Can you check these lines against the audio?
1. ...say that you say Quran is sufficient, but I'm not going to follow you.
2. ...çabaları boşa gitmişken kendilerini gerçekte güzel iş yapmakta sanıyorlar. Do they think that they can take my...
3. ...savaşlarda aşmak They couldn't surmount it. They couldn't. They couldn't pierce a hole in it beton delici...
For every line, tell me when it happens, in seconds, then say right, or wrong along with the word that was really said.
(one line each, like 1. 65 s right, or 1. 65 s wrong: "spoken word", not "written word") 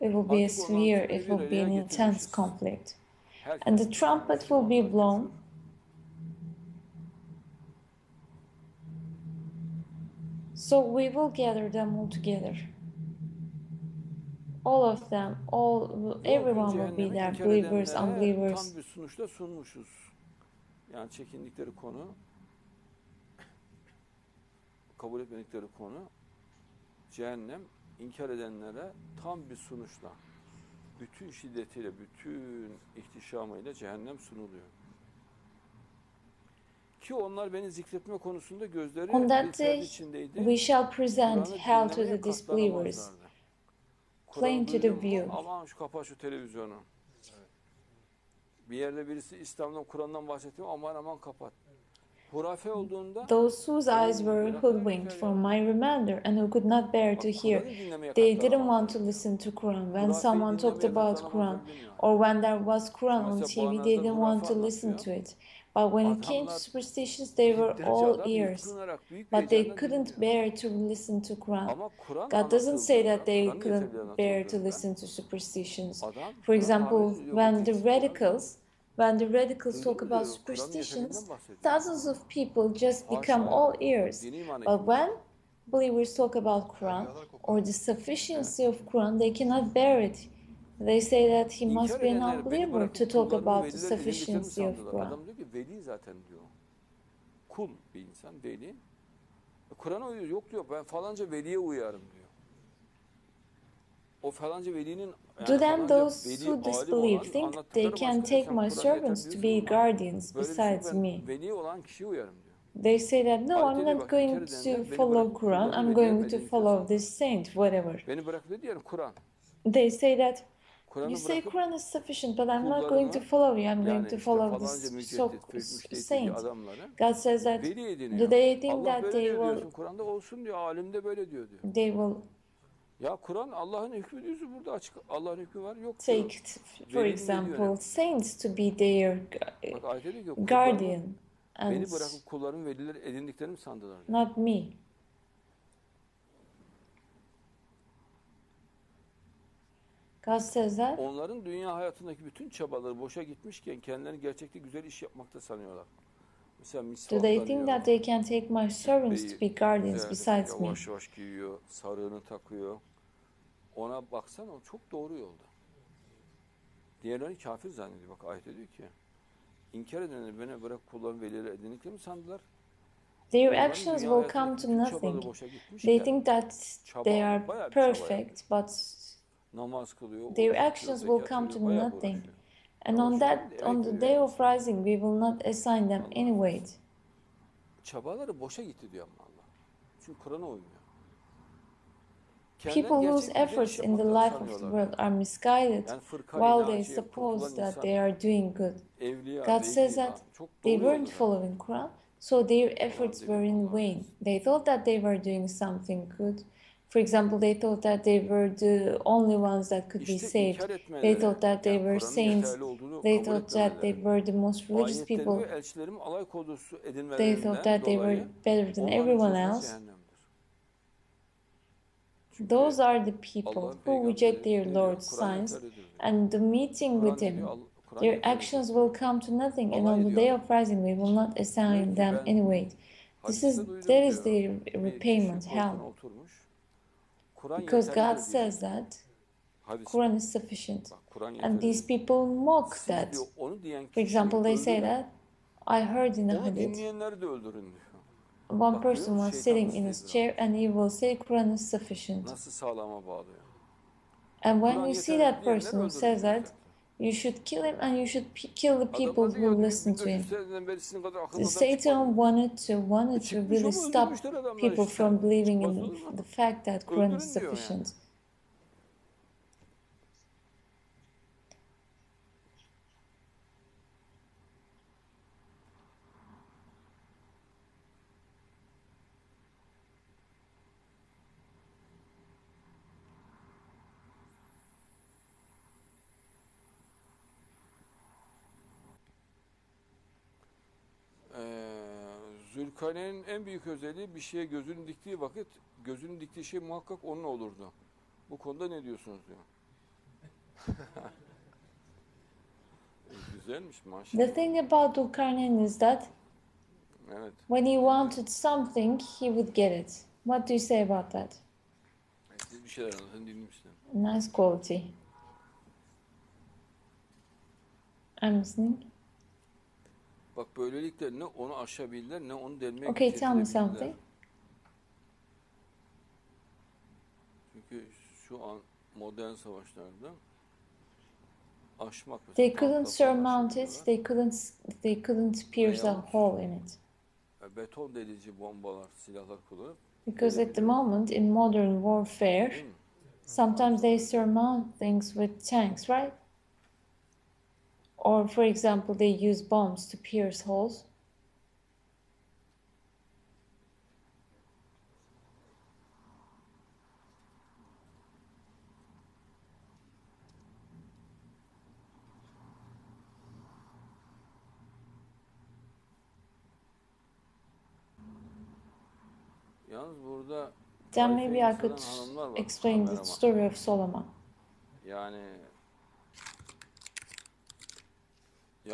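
1. 119 s right
2. 152 s right
3. 329 s right.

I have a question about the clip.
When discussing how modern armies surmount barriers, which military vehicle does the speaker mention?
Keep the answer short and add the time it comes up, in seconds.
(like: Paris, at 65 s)
tanks, at 345 s.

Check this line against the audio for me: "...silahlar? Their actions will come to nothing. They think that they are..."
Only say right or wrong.
wrong.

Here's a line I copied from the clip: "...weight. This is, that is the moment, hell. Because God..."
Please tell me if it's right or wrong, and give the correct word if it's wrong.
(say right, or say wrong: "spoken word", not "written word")
wrong: "repayment", not "moment".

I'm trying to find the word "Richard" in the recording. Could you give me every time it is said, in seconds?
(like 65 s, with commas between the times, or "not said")
not said.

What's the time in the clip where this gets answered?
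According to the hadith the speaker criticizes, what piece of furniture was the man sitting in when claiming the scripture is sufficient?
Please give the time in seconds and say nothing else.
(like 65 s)
249 s.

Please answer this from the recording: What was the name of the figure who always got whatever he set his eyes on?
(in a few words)
Gülkane.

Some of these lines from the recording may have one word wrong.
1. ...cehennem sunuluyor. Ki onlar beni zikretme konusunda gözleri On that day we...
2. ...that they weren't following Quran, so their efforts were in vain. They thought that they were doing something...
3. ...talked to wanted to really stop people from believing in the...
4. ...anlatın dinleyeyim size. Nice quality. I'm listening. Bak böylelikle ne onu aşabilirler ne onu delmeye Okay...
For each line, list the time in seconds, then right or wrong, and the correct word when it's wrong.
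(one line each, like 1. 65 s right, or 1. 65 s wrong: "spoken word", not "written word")
1. 33 s right
2. 199 s right
3. 262 s wrong: "wanted", not "talked"
4. 312 s right.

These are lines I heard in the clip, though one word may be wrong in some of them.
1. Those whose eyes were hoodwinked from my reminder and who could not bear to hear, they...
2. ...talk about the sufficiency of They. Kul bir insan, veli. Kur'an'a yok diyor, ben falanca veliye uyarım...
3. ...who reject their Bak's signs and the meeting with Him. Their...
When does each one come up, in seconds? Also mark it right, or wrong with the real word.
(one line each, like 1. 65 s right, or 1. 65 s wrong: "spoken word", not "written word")
1. 53 s right
2. 93 s wrong: "Quran", not "They"
3. 223 s wrong: "Lord", not "Bak".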